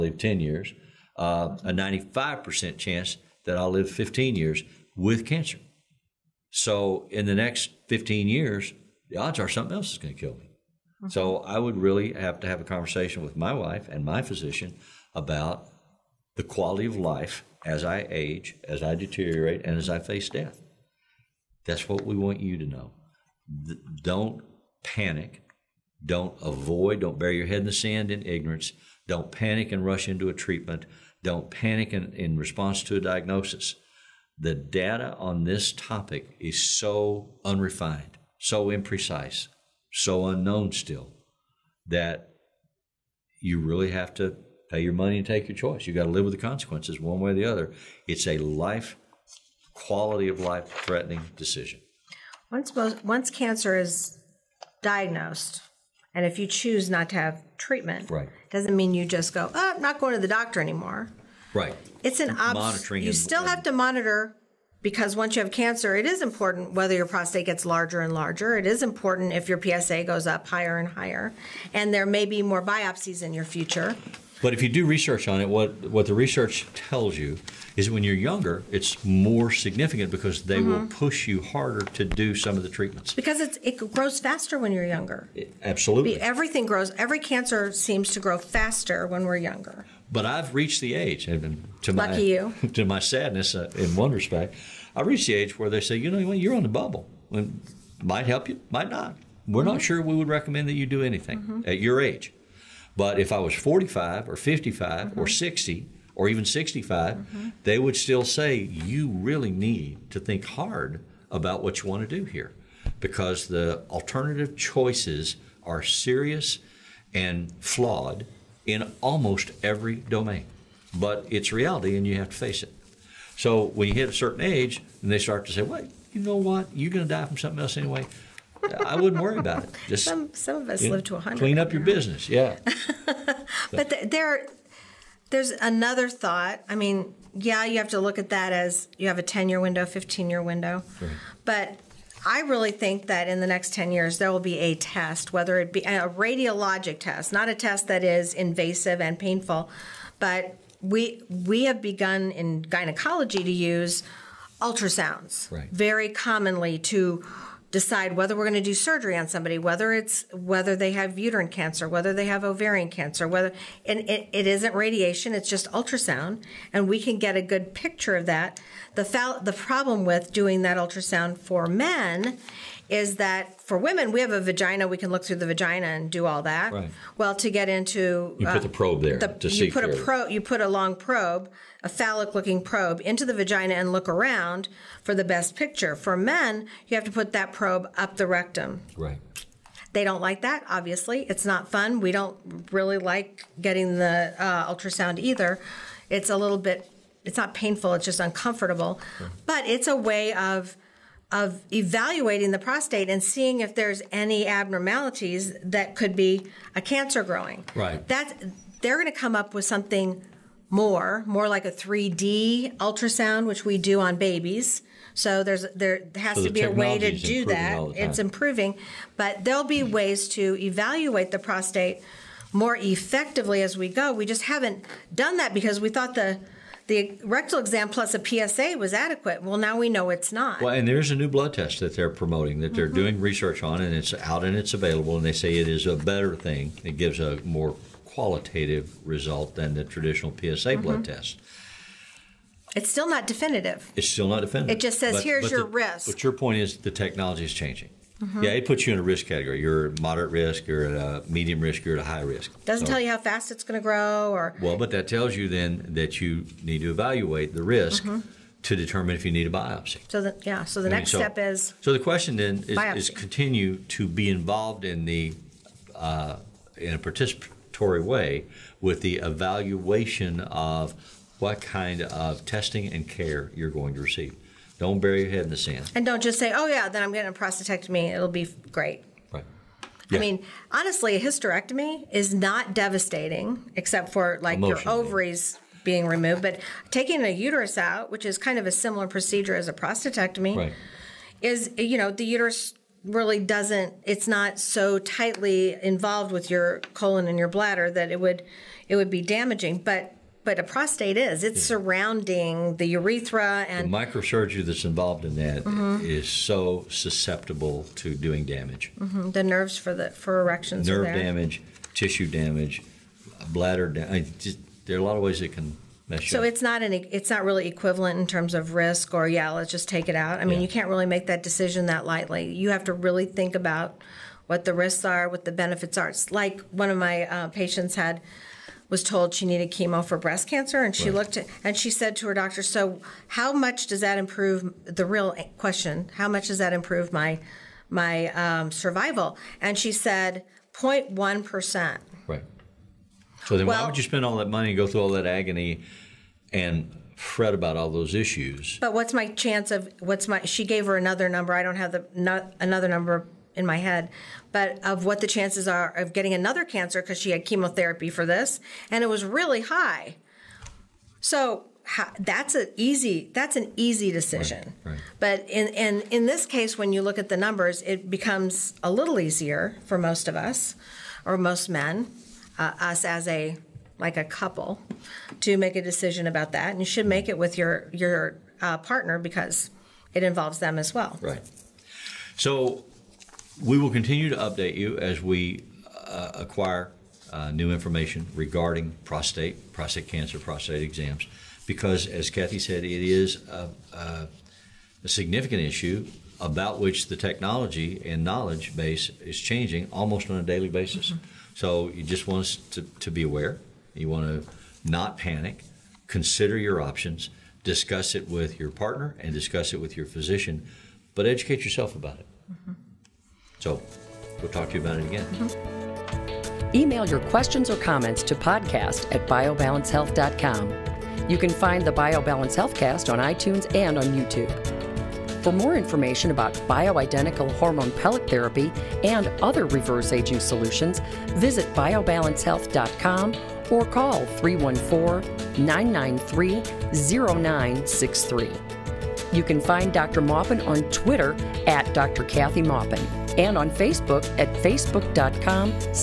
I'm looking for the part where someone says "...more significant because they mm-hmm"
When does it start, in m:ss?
1:19.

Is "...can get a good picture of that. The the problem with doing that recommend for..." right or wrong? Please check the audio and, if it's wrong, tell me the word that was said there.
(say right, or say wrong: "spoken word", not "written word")
wrong: "ultrasound", not "recommend".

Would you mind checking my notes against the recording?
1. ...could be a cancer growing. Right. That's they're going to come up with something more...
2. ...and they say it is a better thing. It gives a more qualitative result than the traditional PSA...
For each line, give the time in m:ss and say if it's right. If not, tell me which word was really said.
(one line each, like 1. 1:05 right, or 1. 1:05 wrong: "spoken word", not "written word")
1. 3:25 right
2. 3:55 right.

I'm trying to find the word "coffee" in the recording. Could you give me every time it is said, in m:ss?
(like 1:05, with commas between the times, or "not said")
not said.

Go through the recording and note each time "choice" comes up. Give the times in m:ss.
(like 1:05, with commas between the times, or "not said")
0:45, 1:54.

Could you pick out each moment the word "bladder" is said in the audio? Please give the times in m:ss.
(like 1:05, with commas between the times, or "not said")
4:57, 5:13.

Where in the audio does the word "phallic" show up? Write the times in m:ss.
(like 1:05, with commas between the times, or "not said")
3:01.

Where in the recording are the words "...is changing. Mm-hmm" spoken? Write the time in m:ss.
4:07.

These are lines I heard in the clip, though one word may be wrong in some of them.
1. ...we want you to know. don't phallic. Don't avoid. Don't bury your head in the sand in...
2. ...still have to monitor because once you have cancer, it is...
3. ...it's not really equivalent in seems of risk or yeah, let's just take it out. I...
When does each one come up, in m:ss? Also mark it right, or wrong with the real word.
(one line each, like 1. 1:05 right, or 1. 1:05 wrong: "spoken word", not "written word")
1. 0:22 wrong: "panic", not "phallic"
2. 1:03 right
3. 5:16 wrong: "terms", not "seems".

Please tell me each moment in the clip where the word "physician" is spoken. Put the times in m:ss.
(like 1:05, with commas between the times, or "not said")
0:14, 6:50.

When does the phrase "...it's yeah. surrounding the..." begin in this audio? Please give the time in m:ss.
5:01.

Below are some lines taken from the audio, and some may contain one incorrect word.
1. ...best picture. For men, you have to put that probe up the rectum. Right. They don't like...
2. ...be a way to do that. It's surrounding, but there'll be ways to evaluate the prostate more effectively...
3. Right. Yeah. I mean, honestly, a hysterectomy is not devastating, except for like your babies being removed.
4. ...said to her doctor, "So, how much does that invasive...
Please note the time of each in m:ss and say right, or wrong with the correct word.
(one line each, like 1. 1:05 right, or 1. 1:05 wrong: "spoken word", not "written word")
1. 3:05 right
2. 3:36 wrong: "improving", not "surrounding"
3. 4:39 wrong: "ovaries", not "babies"
4. 5:31 wrong: "improve", not "invasive".